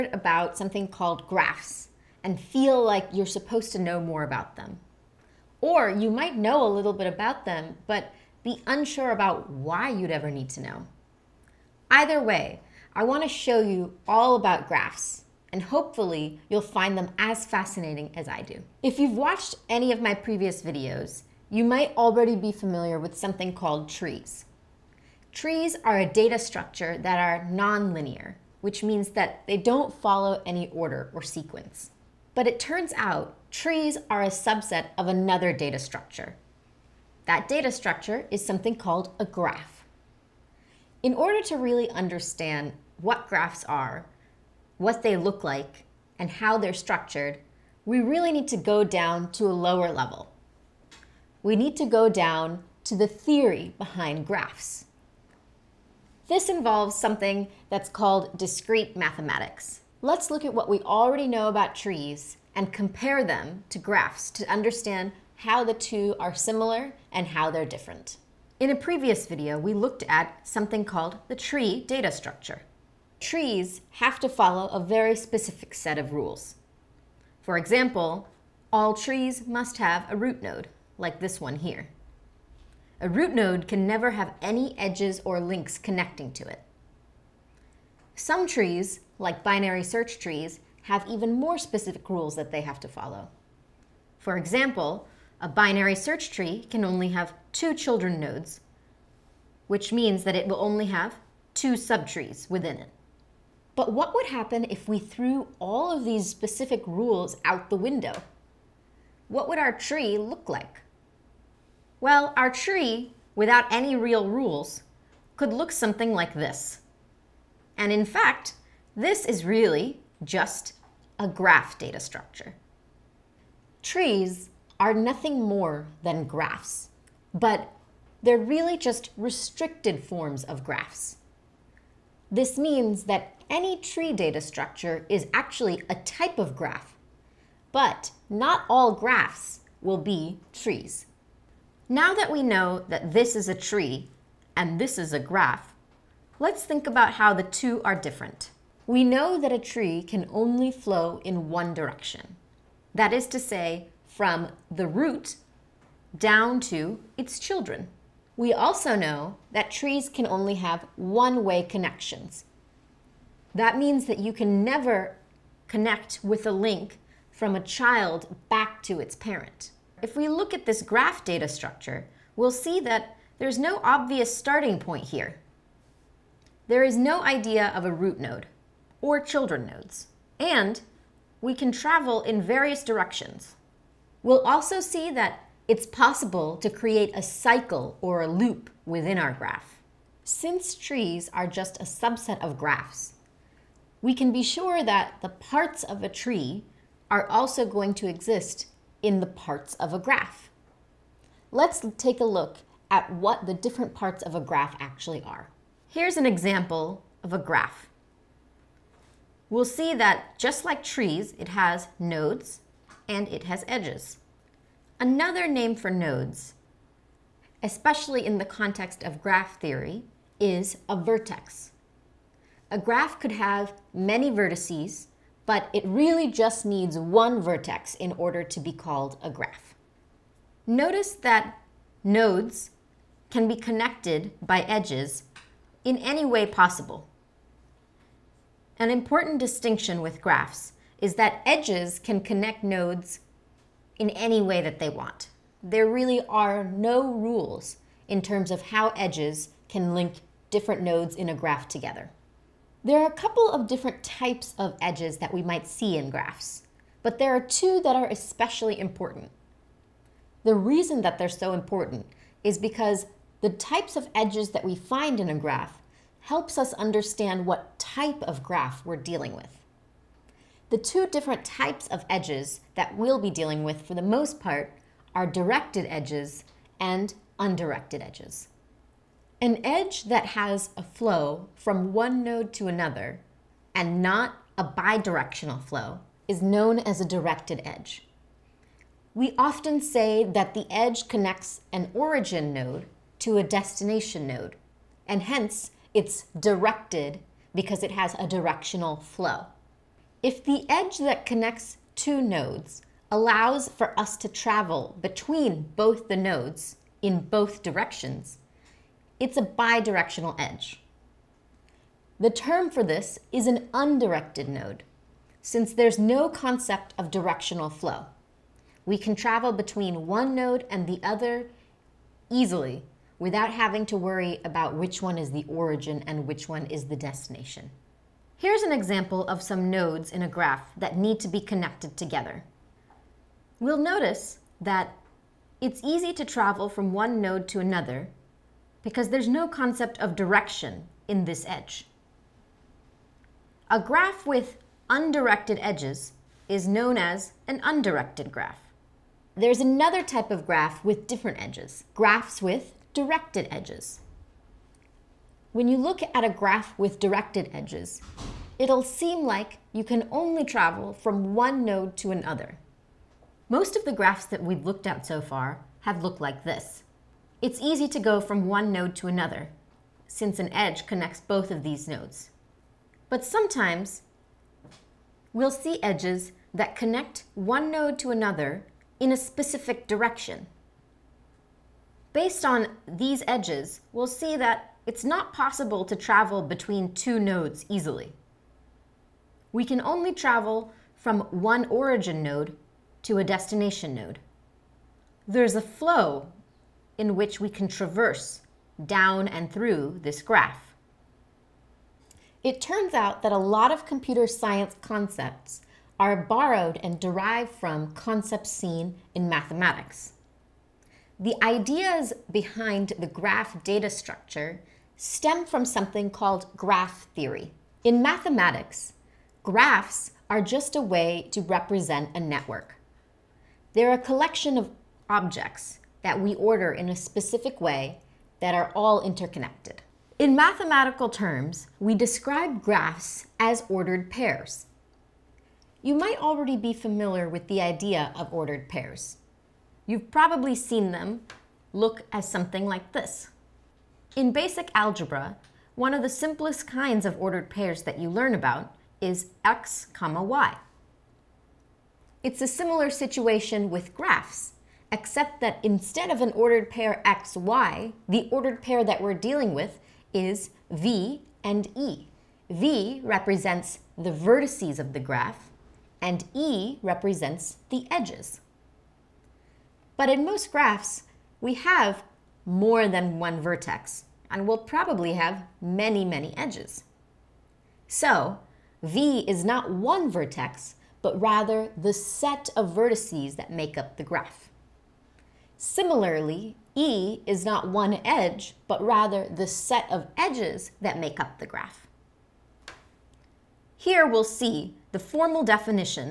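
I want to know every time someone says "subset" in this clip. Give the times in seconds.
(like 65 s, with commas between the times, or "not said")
34 s, 191 s.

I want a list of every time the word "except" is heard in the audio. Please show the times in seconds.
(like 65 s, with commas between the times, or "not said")
454 s.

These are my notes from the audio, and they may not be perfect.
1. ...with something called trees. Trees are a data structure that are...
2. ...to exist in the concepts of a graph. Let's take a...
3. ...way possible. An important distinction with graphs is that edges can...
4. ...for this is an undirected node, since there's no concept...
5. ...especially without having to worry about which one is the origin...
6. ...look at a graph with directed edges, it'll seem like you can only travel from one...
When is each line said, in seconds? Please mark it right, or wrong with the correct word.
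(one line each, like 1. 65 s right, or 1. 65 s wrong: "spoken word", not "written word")
1. 22 s right
2. 197 s wrong: "parts", not "concepts"
3. 236 s right
4. 312 s right
5. 322 s wrong: "easily", not "especially"
6. 355 s right.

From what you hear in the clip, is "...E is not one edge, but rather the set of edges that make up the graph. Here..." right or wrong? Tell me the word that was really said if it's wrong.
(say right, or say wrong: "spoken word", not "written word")
right.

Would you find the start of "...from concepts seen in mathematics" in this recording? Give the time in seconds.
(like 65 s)
407 s.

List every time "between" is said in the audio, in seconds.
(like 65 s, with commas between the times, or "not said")
305 s, 319 s, 386 s.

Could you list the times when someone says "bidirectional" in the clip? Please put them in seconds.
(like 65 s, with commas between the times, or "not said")
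284 s, 309 s.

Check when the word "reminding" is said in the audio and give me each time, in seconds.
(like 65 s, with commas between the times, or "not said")
not said.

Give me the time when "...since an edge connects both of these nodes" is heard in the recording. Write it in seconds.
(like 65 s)
370 s.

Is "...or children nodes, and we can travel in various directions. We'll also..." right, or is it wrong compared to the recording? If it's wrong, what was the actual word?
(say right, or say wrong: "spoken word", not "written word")
right.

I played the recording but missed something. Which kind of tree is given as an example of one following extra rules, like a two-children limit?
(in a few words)
Binary search trees.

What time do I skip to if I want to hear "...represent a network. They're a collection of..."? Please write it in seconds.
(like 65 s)
421 s.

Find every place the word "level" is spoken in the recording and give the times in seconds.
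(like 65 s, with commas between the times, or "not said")
49 s.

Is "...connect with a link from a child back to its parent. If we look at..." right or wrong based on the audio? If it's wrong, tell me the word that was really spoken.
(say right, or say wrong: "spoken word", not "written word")
right.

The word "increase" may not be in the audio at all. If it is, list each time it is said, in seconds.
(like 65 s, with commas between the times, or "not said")
not said.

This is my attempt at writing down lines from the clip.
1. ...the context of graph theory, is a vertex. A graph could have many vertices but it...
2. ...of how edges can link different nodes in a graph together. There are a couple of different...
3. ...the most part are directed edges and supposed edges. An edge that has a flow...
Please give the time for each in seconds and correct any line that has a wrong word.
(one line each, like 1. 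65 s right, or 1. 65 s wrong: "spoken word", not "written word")
1. 218 s right
2. 248 s right
3. 273 s wrong: "undirected", not "supposed".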